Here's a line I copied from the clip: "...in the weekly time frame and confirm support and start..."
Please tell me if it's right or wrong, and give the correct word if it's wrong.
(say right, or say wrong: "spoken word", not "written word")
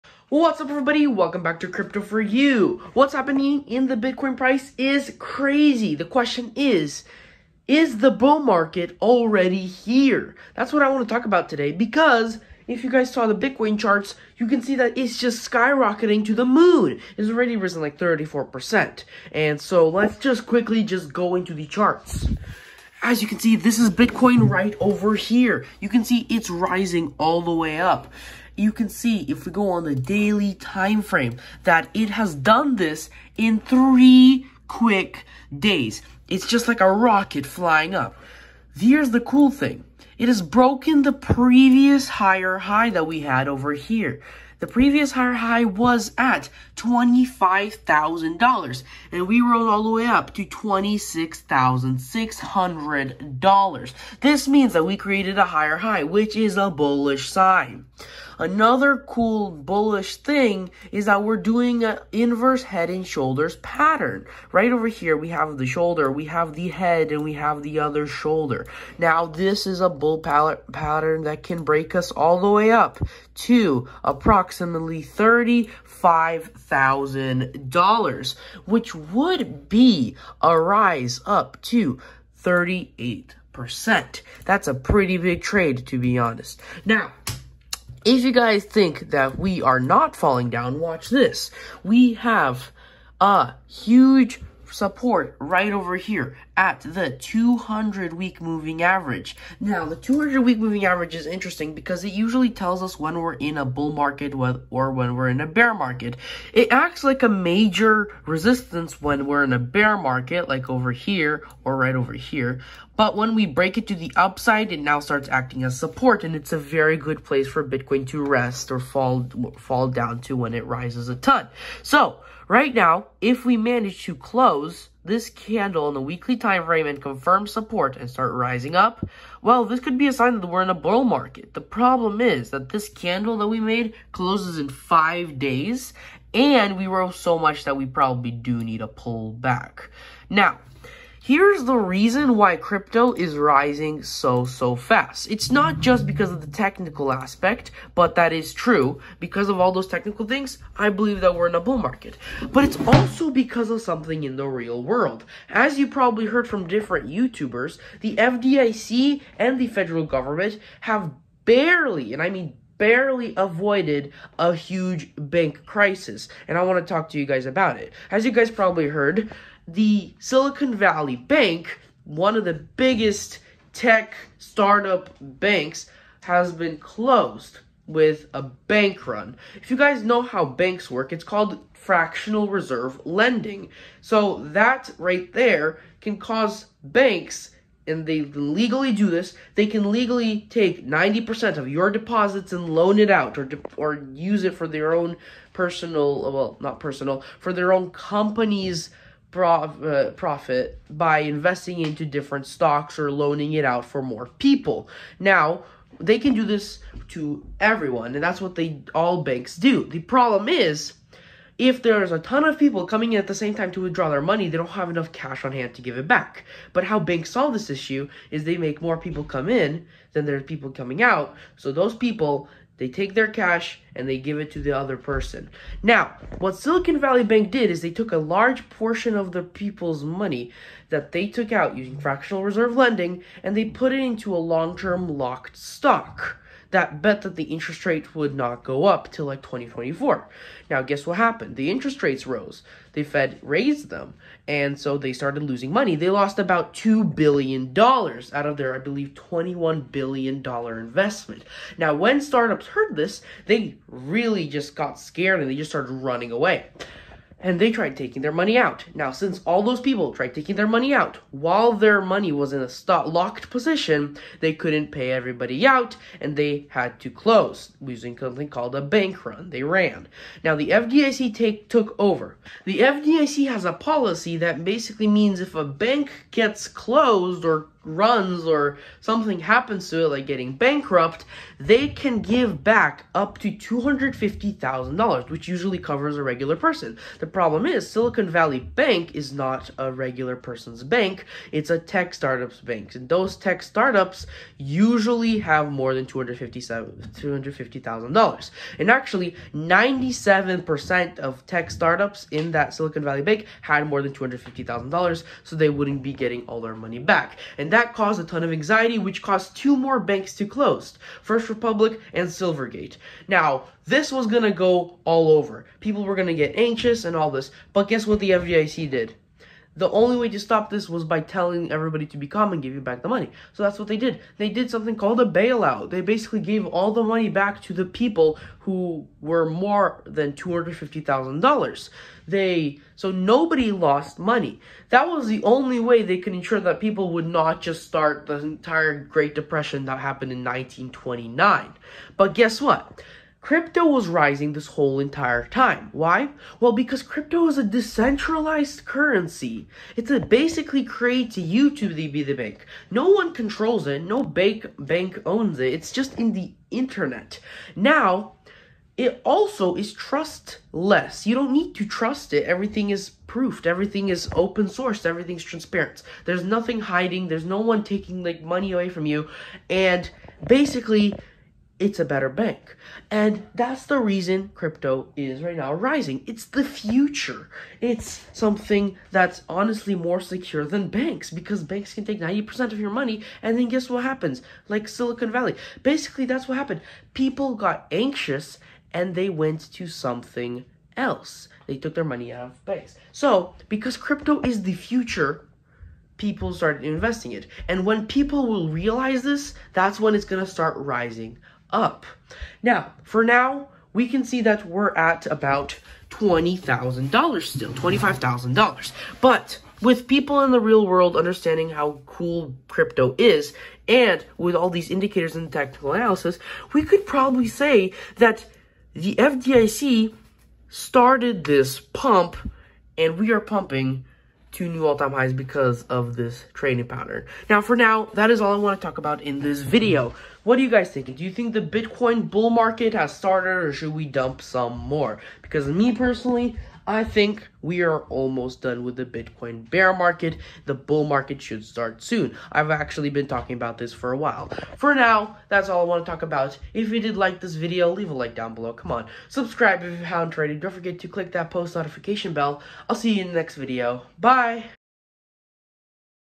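right.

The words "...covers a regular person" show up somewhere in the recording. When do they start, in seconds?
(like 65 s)
285 s.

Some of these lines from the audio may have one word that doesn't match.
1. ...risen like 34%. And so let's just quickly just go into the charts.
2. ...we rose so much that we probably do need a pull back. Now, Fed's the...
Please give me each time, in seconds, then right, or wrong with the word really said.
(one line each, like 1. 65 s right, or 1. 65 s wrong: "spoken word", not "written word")
1. 17 s right
2. 136 s wrong: "Here", not "Fed".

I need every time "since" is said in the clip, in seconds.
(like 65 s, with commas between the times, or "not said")
259 s.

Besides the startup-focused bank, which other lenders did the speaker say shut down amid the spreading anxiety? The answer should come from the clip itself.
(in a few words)
First Republic and Silvergate.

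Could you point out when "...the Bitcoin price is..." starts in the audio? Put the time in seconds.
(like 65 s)
3 s.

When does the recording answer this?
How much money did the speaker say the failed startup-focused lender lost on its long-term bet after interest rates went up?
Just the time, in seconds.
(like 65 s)
246 s.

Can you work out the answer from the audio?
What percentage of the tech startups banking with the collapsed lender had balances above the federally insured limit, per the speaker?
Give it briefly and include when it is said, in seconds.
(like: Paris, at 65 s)
97%, at 299 s.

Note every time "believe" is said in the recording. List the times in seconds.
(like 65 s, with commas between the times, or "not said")
150 s, 248 s.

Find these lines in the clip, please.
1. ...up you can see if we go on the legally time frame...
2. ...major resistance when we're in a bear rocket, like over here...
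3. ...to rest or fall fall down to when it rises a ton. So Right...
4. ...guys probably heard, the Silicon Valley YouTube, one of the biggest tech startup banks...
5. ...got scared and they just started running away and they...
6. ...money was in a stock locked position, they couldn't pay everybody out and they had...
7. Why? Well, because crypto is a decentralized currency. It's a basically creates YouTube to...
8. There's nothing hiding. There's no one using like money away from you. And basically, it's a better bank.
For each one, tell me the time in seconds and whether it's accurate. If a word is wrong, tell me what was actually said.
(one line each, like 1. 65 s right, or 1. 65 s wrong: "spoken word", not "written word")
1. 27 s wrong: "daily", not "legally"
2. 107 s wrong: "market", not "rocket"
3. 118 s right
4. 168 s wrong: "Bank", not "YouTube"
5. 254 s right
6. 262 s right
7. 345 s right
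8. 366 s wrong: "taking", not "using".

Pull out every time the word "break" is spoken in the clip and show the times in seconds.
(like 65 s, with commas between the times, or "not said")
71 s, 113 s.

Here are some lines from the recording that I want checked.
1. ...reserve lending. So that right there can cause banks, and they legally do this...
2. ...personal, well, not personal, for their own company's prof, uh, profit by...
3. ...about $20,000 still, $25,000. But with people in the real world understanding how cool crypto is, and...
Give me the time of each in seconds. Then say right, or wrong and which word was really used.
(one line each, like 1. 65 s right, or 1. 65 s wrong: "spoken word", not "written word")
1. 182 s right
2. 195 s right
3. 405 s right.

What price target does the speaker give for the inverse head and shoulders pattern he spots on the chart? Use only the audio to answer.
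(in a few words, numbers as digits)
$35,000.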